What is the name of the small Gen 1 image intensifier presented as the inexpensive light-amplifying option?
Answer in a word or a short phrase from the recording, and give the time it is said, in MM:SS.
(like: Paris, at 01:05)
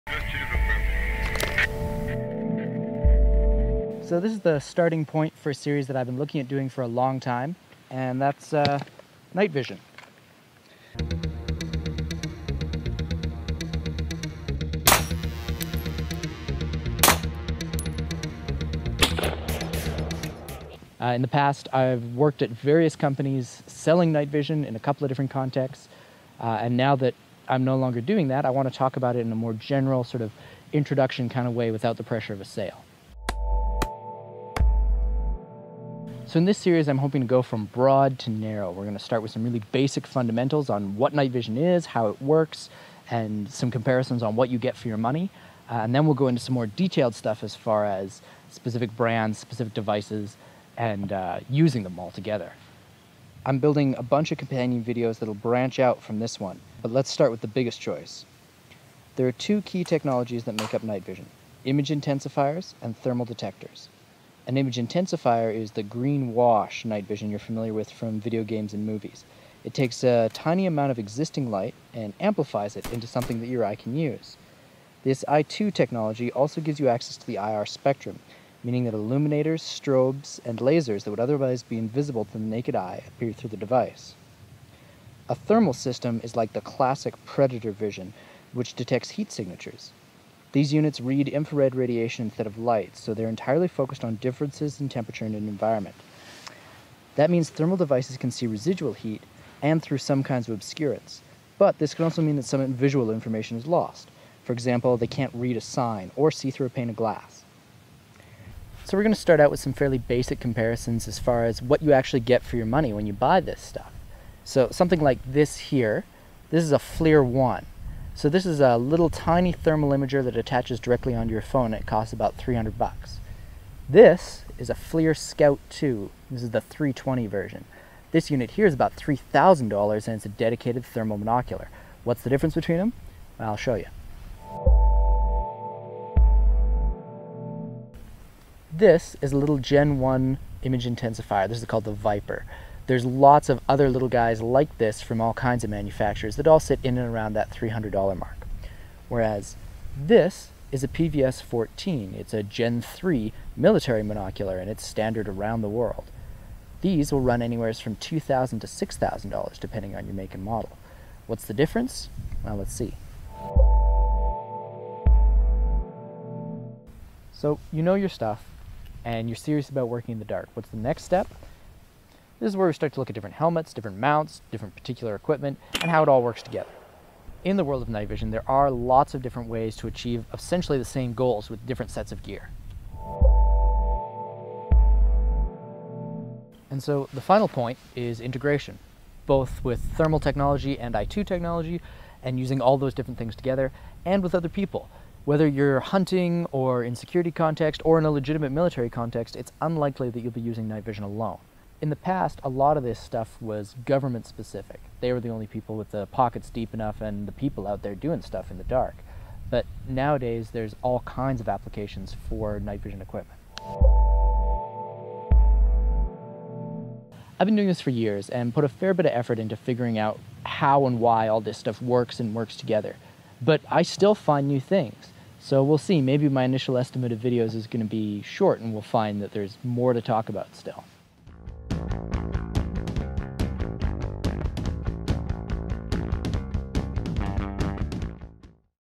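Viper, at 02:21.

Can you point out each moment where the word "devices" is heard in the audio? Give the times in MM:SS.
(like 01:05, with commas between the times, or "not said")
00:49, 01:23, 01:37.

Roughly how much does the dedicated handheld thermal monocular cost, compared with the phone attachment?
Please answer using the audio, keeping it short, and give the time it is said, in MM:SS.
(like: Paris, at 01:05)
$3,000, at 02:08.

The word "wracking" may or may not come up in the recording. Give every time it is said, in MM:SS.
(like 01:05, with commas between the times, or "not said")
not said.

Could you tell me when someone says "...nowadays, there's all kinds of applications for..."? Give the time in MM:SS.
03:29.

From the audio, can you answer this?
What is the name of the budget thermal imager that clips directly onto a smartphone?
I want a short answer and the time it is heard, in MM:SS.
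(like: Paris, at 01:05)
FLIR 1, at 01:56.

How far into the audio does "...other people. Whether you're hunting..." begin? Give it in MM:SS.
03:14.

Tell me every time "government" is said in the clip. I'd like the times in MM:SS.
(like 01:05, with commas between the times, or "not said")
03:23.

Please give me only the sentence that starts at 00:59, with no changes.
There are two key technologies that make up night vision, image intensifiers and thermal detectors.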